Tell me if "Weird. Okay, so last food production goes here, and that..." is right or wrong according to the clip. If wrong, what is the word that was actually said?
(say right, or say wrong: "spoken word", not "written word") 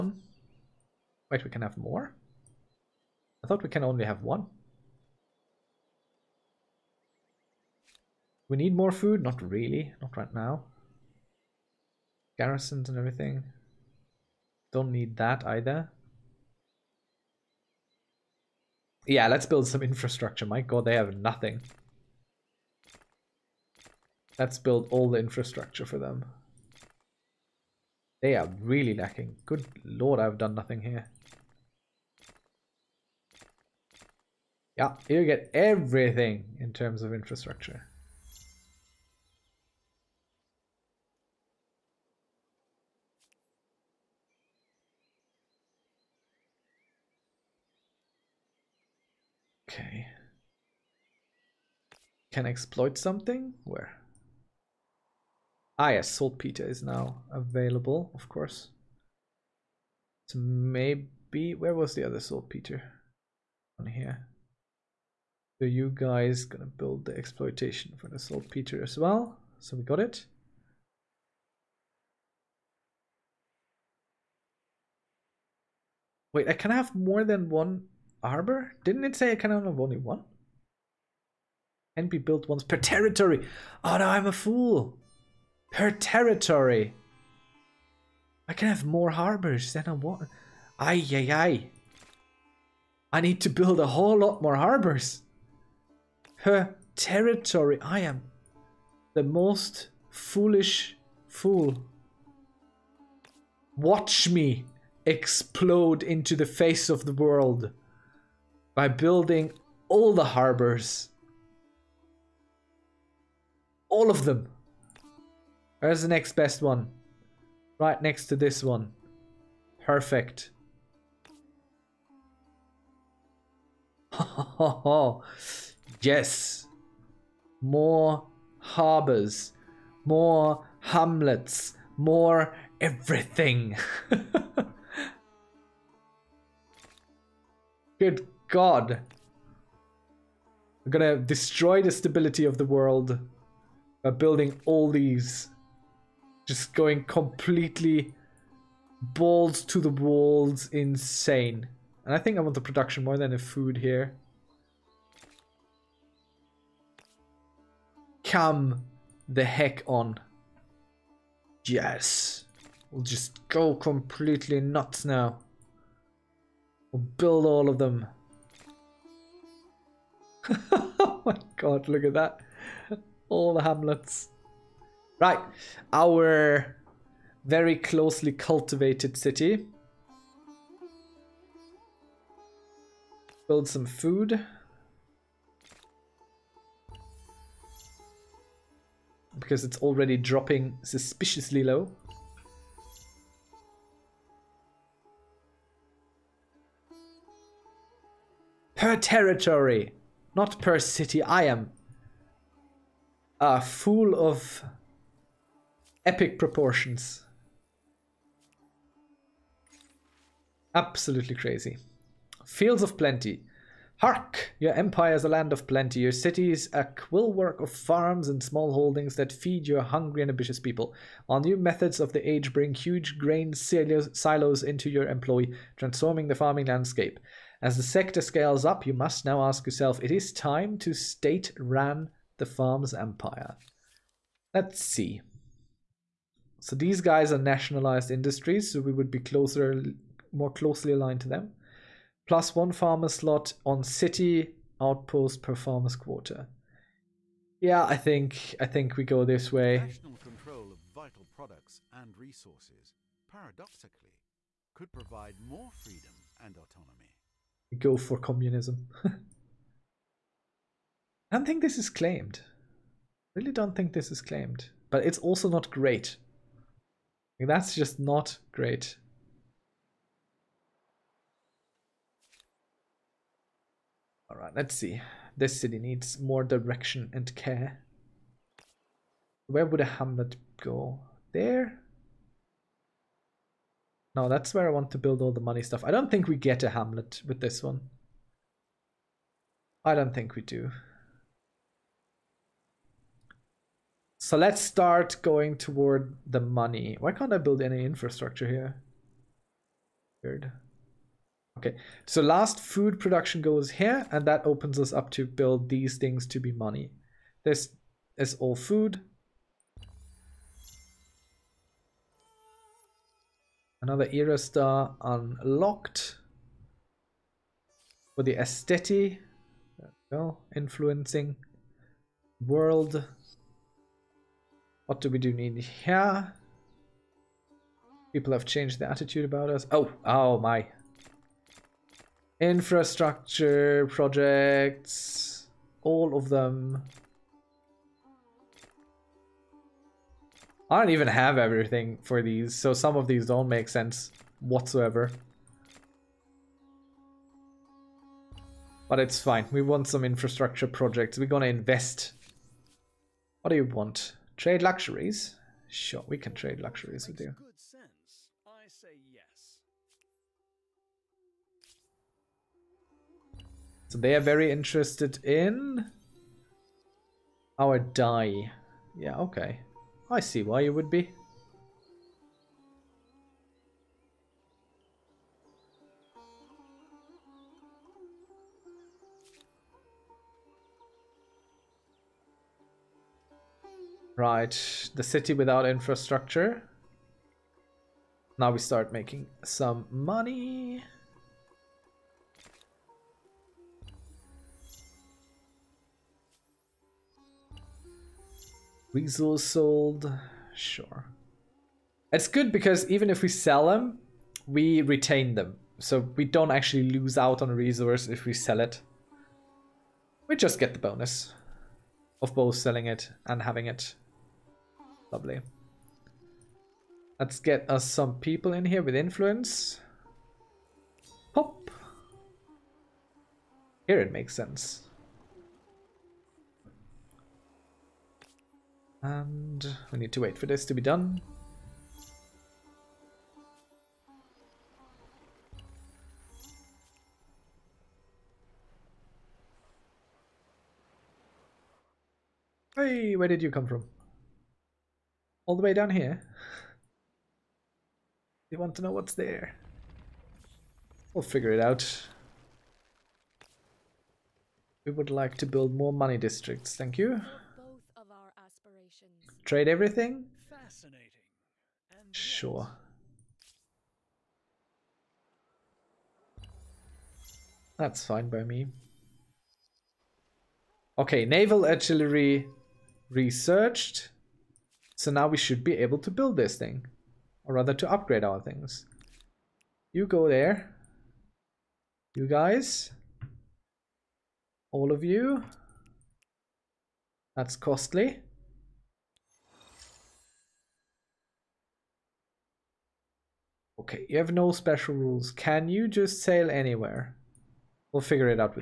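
right.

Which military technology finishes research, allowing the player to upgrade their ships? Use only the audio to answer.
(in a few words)
Naval artillery.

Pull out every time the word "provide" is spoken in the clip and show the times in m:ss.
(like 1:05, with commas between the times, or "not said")
4:14.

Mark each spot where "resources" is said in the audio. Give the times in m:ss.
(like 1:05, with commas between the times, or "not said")
4:12, 6:38, 6:47.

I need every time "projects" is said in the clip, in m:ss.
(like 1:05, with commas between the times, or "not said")
5:33, 5:50.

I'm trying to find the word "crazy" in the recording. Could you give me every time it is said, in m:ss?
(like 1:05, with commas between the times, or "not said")
3:31.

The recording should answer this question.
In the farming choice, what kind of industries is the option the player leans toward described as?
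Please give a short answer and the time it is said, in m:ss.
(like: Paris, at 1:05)
Nationalized industries, at 3:57.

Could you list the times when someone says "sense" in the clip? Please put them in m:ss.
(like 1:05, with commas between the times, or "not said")
5:43, 7:04.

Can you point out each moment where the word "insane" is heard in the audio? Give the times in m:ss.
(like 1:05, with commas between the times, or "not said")
2:30.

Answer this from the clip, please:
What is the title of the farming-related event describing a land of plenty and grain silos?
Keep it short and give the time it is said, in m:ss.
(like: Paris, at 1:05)
Fields of plenty, at 3:32.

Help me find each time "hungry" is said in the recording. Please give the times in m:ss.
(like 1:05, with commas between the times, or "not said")
3:39.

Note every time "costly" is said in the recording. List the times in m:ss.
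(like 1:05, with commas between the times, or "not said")
8:07.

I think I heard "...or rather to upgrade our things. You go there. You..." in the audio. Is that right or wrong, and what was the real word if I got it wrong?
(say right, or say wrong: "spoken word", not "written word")
right.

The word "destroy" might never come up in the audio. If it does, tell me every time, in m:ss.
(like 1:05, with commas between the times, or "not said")
2:21.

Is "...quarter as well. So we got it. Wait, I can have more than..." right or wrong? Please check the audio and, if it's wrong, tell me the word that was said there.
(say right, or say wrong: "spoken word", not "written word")
wrong: "saltpeter", not "quarter".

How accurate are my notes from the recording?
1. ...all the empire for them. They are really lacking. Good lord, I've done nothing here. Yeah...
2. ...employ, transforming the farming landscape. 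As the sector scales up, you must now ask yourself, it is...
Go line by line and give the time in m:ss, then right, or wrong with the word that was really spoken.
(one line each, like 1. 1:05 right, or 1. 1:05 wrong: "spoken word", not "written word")
1. 0:24 wrong: "infrastructure", not "empire"
2. 3:45 right.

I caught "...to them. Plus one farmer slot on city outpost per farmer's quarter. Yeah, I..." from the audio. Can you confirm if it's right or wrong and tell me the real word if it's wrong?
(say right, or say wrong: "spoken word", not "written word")
right.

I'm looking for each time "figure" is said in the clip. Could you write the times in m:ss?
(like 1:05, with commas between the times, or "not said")
7:31, 8:18.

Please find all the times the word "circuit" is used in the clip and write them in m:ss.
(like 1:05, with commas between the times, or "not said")
not said.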